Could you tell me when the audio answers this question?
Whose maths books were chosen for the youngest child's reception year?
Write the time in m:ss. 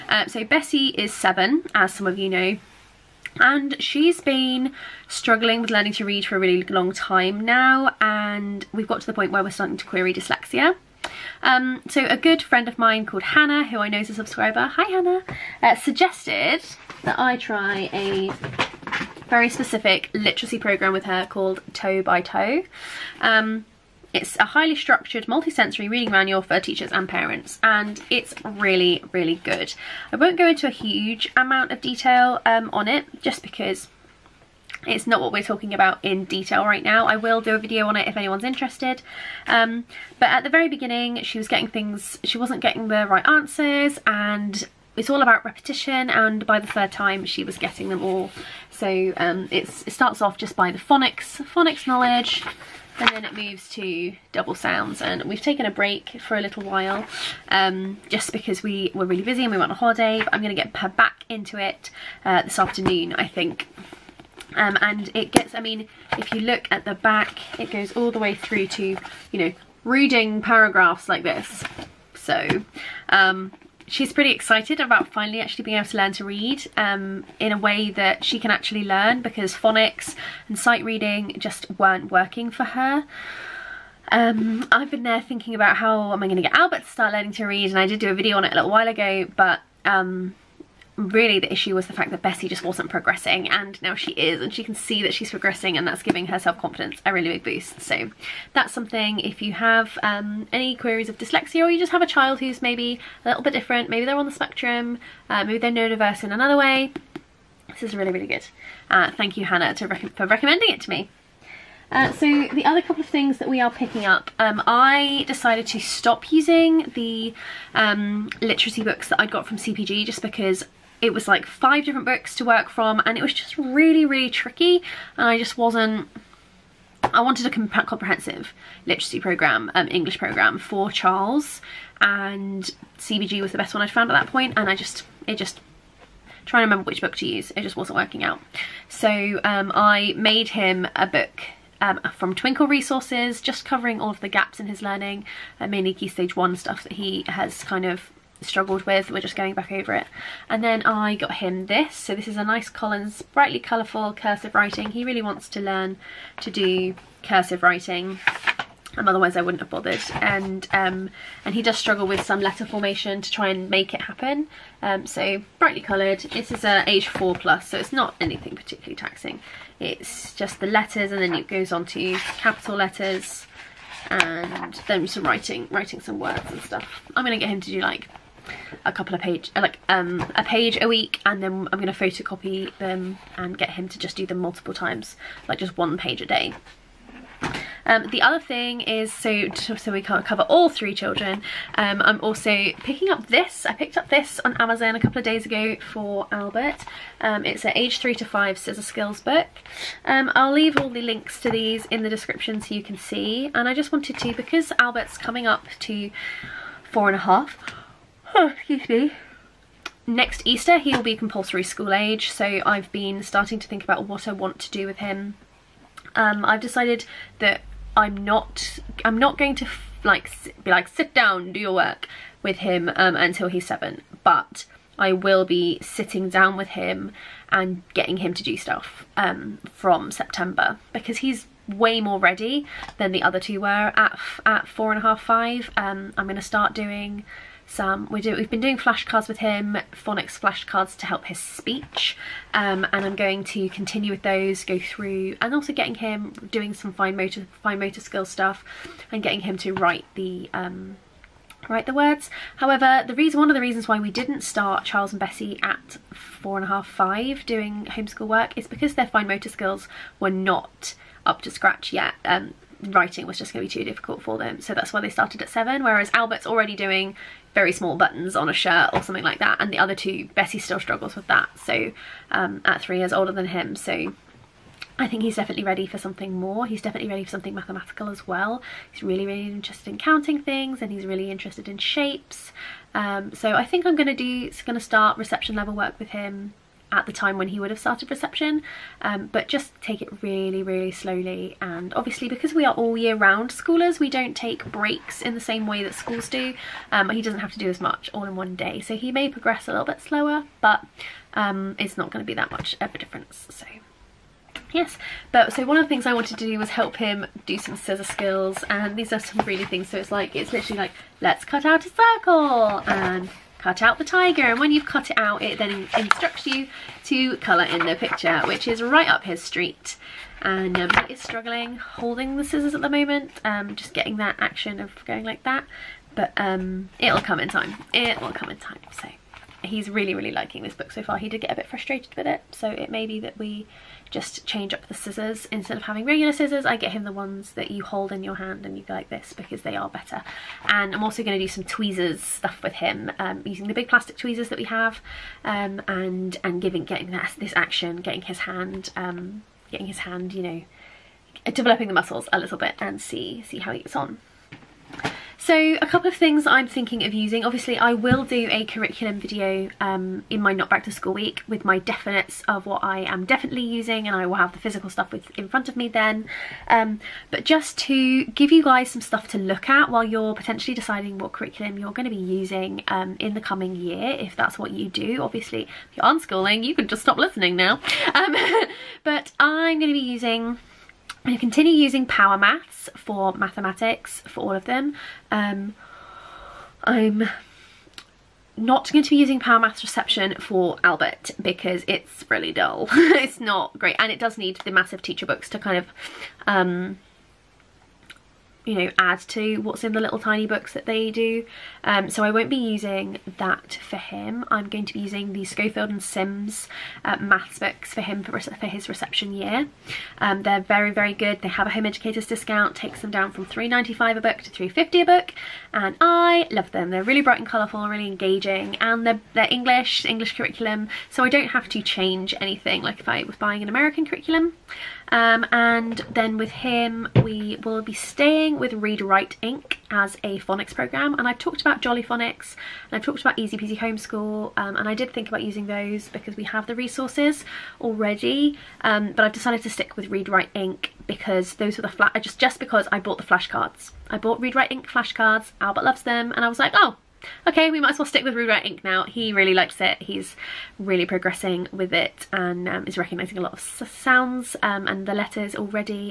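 6:45.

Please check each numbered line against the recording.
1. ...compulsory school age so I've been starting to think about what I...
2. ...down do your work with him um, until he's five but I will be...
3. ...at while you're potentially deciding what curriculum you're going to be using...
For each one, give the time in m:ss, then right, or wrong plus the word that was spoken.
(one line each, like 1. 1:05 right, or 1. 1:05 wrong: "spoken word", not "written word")
1. 3:31 right
2. 3:41 wrong: "seven", not "five"
3. 6:09 right.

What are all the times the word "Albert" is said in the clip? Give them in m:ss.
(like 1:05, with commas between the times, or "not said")
1:26, 3:16, 3:24, 4:26, 6:30, 7:25.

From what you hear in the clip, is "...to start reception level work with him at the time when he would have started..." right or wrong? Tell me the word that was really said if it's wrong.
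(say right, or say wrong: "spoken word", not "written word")
right.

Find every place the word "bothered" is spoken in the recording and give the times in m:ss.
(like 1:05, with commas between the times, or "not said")
2:39.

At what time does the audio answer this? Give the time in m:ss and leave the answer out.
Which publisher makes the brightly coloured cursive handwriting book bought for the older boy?
2:32.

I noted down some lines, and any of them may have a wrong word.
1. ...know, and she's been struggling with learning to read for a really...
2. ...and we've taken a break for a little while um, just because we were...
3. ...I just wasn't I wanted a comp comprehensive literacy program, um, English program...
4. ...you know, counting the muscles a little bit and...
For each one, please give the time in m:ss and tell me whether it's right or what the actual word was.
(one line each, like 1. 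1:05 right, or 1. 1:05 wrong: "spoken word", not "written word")
1. 0:02 right
2. 0:55 right
3. 2:05 right
4. 5:50 wrong: "developing", not "counting".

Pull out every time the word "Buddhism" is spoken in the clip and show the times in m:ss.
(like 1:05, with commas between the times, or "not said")
not said.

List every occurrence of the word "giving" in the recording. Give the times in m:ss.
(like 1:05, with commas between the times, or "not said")
1:36, 5:46.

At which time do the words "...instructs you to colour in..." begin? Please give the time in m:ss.
5:15.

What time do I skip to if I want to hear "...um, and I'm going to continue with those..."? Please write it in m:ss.
4:02.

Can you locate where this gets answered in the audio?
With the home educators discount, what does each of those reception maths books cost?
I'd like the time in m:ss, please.
6:54.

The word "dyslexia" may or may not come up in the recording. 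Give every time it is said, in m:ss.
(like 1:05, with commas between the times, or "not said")
0:10, 1:41.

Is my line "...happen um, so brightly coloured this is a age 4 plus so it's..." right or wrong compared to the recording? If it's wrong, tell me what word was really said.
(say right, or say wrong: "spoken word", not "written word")
right.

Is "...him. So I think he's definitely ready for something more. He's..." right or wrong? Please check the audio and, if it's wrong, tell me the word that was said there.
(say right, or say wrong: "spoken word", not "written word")
right.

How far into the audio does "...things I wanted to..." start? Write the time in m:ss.
5:05.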